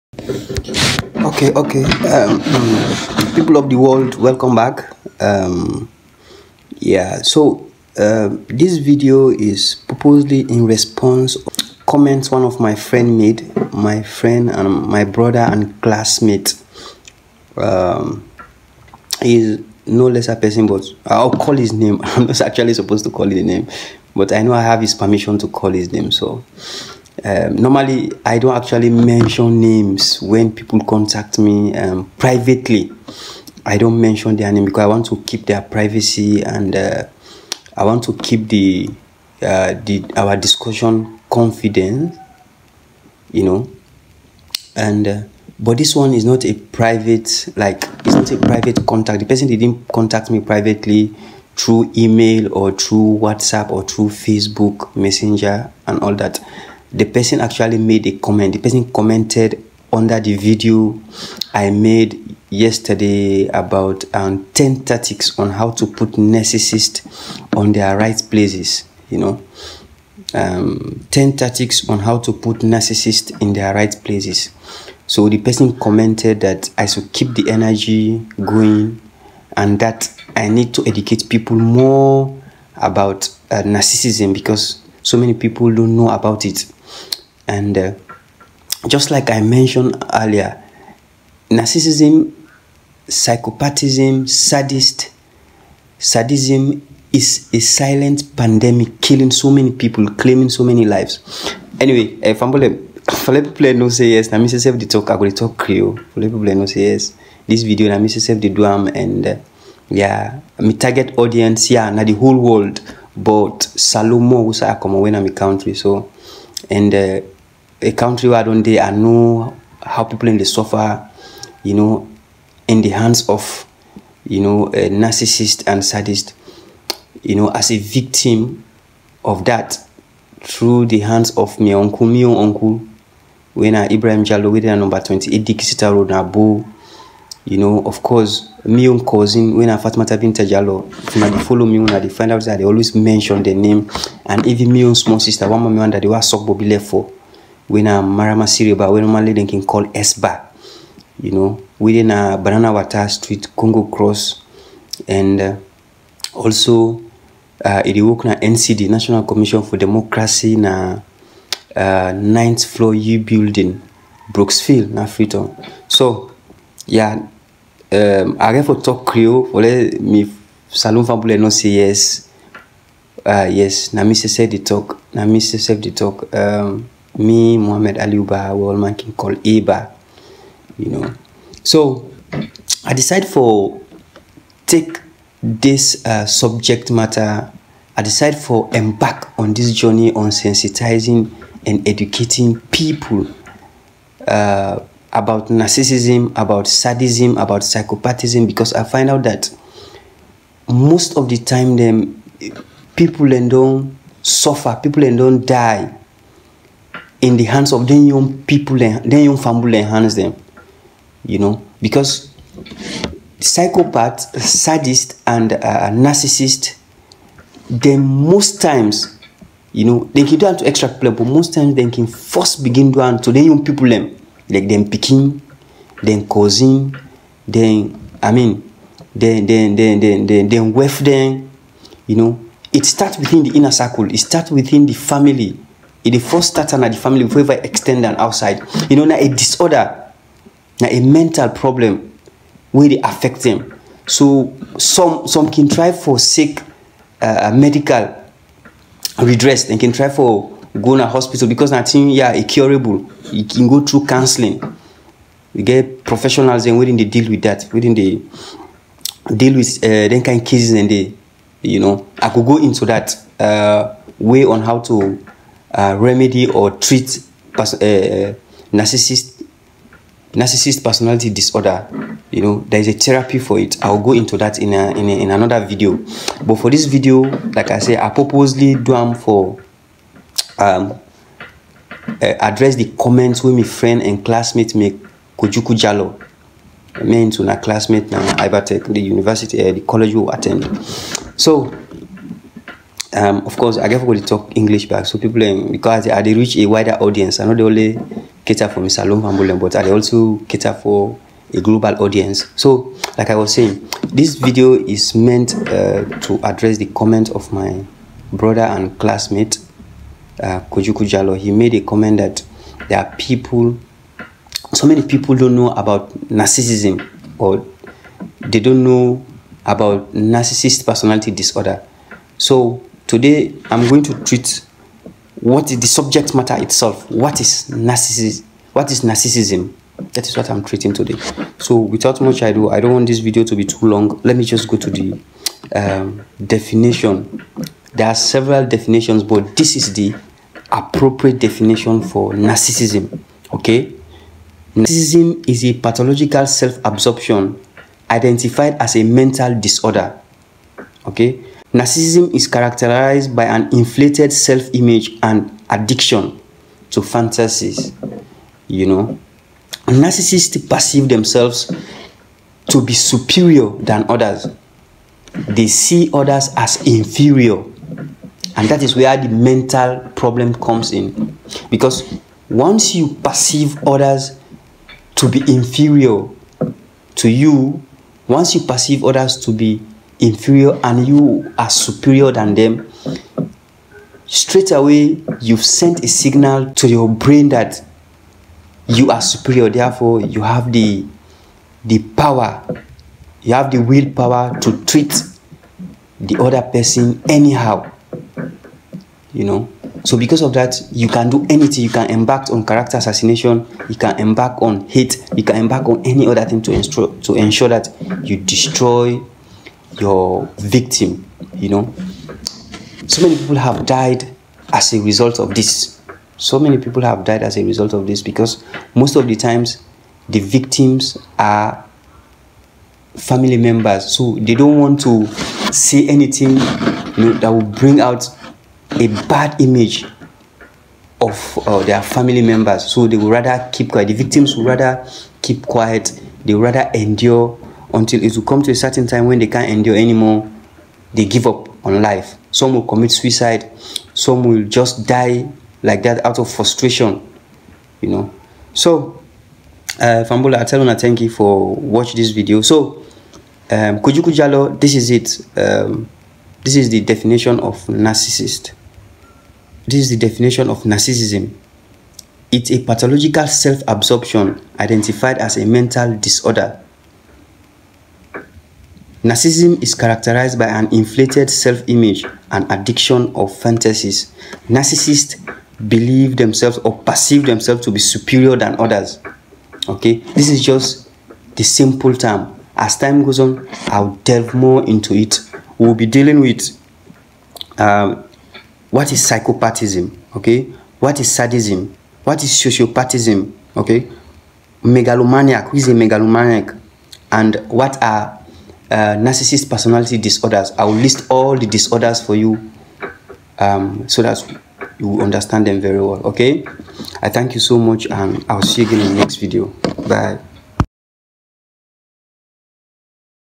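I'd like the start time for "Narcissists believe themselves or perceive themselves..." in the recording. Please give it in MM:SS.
07:54.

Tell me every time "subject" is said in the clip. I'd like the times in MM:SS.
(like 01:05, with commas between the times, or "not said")
03:06, 05:25.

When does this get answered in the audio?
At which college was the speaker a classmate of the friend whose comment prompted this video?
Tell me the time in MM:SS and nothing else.
04:48.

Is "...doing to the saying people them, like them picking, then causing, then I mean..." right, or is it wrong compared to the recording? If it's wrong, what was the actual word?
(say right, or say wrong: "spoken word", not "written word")
wrong: "young", not "saying".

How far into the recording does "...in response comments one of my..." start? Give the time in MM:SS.
00:10.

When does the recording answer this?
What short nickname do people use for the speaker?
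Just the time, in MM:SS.
02:59.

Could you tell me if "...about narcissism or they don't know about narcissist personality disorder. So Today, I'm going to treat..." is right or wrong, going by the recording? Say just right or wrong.
right.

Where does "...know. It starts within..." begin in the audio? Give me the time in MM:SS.
03:52.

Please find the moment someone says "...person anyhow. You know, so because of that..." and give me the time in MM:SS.
06:36.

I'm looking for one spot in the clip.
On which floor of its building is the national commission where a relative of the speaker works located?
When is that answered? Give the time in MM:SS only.
02:42.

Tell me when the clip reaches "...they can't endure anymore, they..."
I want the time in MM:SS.
07:19.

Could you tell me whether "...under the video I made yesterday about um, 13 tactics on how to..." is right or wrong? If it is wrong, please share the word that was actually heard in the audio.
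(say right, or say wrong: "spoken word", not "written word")
wrong: "10", not "13".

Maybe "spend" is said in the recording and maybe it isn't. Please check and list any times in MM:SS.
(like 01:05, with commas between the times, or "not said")
not said.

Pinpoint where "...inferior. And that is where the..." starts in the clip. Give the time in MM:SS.
06:06.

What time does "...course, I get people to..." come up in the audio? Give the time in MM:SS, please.
04:53.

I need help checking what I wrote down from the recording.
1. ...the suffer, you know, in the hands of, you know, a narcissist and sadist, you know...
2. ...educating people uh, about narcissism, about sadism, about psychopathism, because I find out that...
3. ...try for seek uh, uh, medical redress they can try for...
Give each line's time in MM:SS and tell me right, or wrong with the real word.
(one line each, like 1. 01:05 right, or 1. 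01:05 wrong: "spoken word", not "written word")
1. 02:00 right
2. 03:11 right
3. 04:05 right.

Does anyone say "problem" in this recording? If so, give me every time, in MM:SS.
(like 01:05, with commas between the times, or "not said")
04:01, 06:10.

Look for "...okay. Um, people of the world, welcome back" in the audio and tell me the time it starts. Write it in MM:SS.
00:01.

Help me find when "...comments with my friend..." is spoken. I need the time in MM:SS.
04:42.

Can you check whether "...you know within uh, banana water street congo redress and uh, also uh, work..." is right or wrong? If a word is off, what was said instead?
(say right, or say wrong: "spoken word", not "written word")
wrong: "cross", not "redress".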